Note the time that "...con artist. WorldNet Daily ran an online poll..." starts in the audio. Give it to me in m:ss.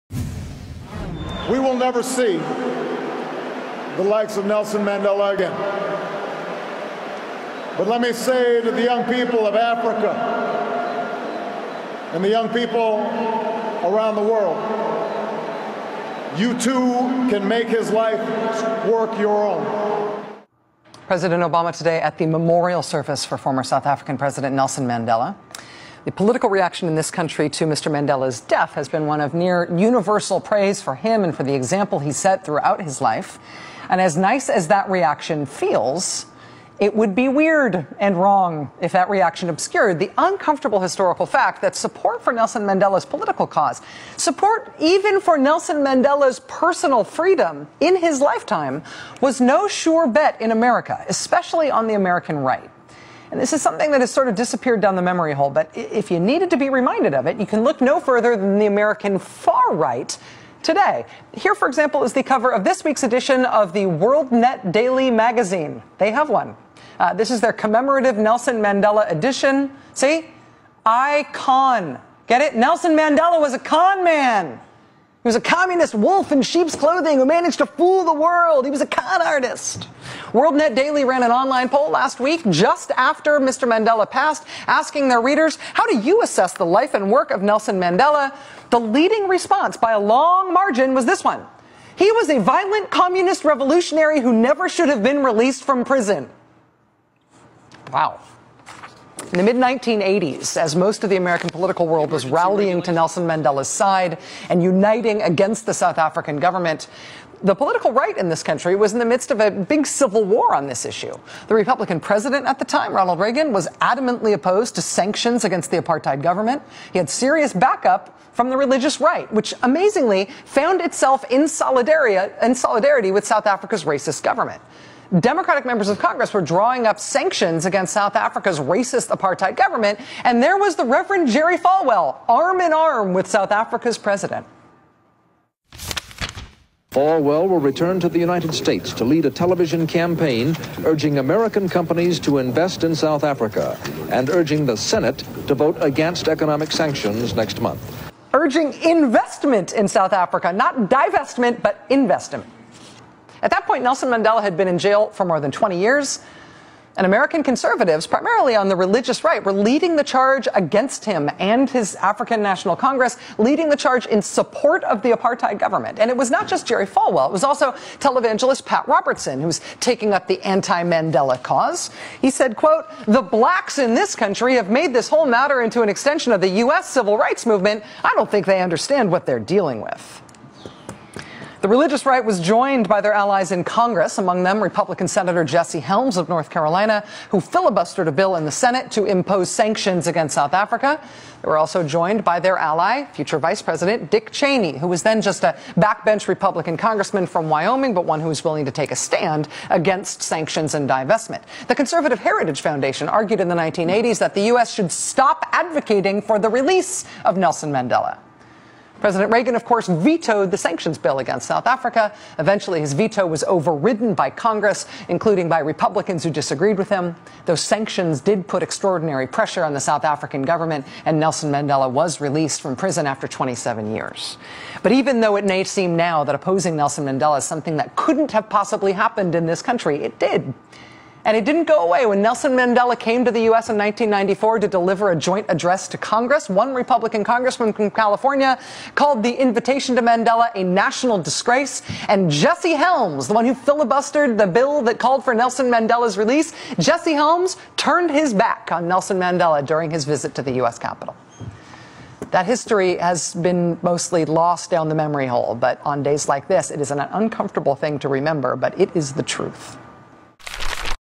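1:18.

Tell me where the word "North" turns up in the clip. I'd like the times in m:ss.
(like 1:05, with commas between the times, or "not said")
3:06.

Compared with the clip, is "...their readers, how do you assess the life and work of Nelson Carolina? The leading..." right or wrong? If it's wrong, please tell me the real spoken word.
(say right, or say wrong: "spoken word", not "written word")
wrong: "Mandela", not "Carolina".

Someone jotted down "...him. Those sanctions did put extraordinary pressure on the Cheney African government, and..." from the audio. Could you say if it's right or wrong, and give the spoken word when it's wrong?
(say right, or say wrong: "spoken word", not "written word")
wrong: "South", not "Cheney".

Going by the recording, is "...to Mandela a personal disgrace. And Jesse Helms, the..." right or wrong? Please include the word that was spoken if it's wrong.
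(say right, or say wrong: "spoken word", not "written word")
wrong: "national", not "personal".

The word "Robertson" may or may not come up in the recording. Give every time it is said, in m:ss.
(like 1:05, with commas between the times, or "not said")
2:48.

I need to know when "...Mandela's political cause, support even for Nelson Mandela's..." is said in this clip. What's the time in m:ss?
0:42.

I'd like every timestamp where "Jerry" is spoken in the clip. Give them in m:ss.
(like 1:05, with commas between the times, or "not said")
2:11, 2:46.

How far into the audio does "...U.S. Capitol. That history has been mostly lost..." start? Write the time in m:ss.
4:10.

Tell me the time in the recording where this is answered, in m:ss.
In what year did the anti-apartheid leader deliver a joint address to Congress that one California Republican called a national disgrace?
3:53.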